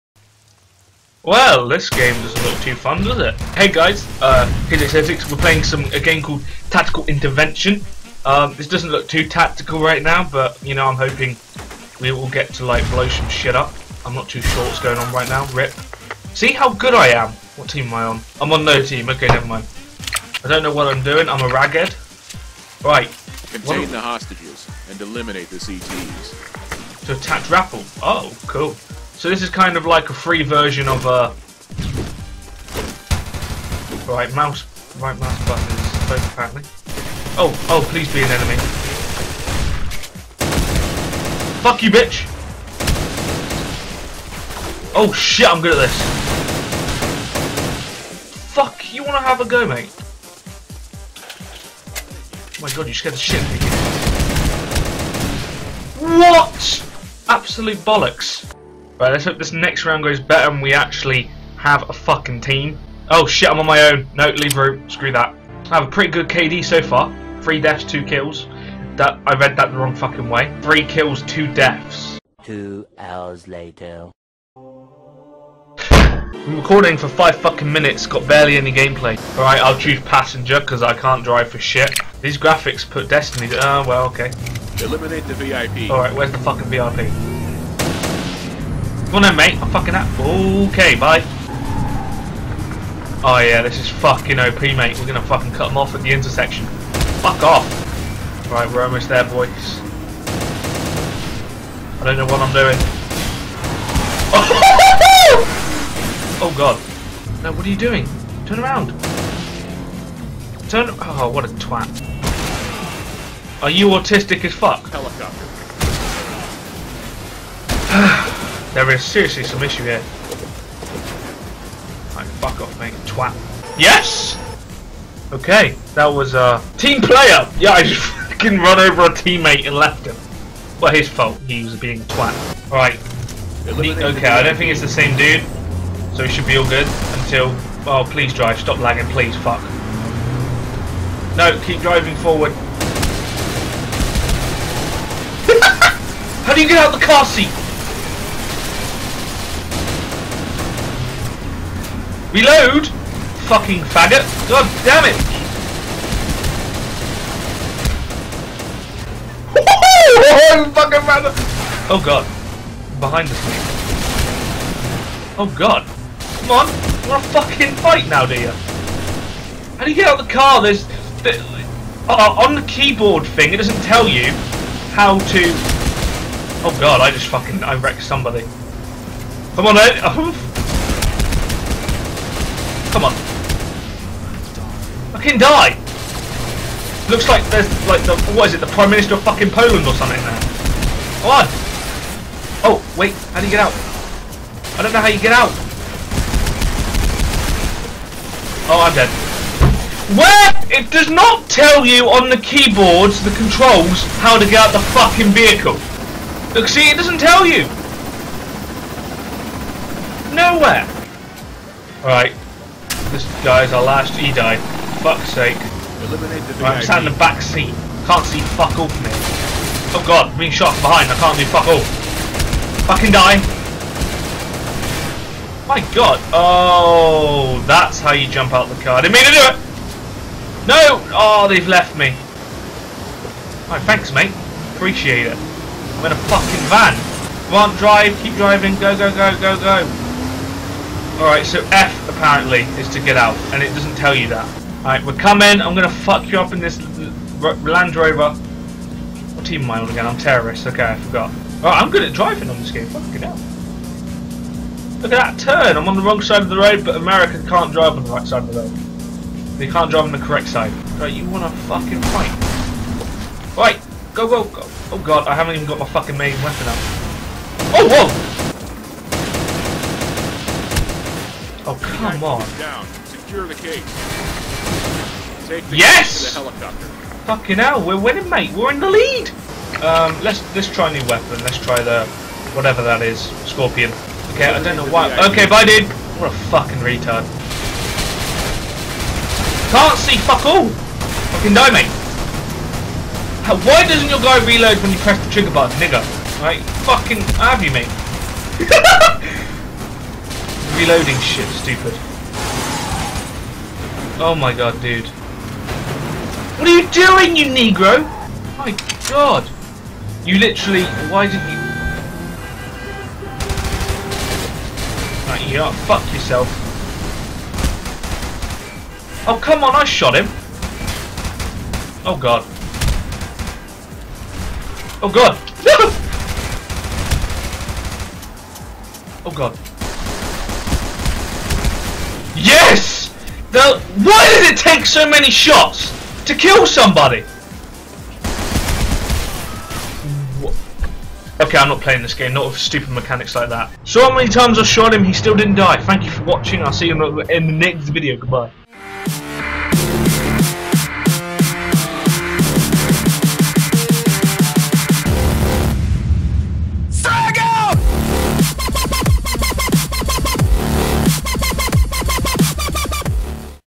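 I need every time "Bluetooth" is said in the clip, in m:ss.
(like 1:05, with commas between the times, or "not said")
not said.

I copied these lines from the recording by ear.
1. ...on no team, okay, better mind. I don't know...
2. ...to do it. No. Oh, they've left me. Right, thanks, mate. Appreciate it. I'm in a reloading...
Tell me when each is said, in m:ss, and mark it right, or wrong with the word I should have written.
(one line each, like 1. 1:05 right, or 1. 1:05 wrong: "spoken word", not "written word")
1. 0:18 wrong: "never", not "better"
2. 3:49 wrong: "fucking", not "reloading".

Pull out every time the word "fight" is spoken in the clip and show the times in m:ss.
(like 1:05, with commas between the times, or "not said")
2:47, 4:22.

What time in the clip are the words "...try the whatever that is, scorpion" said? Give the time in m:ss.
4:41.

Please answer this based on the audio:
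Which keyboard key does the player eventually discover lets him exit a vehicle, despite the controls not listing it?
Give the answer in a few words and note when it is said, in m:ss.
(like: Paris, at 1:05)
F, at 4:01.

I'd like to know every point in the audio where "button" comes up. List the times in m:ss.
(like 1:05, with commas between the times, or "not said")
0:35, 4:55.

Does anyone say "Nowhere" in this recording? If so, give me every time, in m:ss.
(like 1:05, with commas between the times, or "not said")
3:30.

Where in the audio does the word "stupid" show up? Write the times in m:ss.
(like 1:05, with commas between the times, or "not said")
5:01, 5:42.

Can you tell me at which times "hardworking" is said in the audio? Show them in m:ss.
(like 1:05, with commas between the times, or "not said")
not said.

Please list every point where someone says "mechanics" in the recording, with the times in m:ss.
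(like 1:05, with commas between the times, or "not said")
5:42.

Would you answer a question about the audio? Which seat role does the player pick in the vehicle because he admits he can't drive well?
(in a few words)
Passenger.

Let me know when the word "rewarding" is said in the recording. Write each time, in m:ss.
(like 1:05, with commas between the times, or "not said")
not said.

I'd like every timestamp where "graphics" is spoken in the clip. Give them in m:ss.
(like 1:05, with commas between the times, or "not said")
1:22.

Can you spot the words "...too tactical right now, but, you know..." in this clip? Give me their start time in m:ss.
0:09.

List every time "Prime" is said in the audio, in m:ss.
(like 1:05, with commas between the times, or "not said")
3:08.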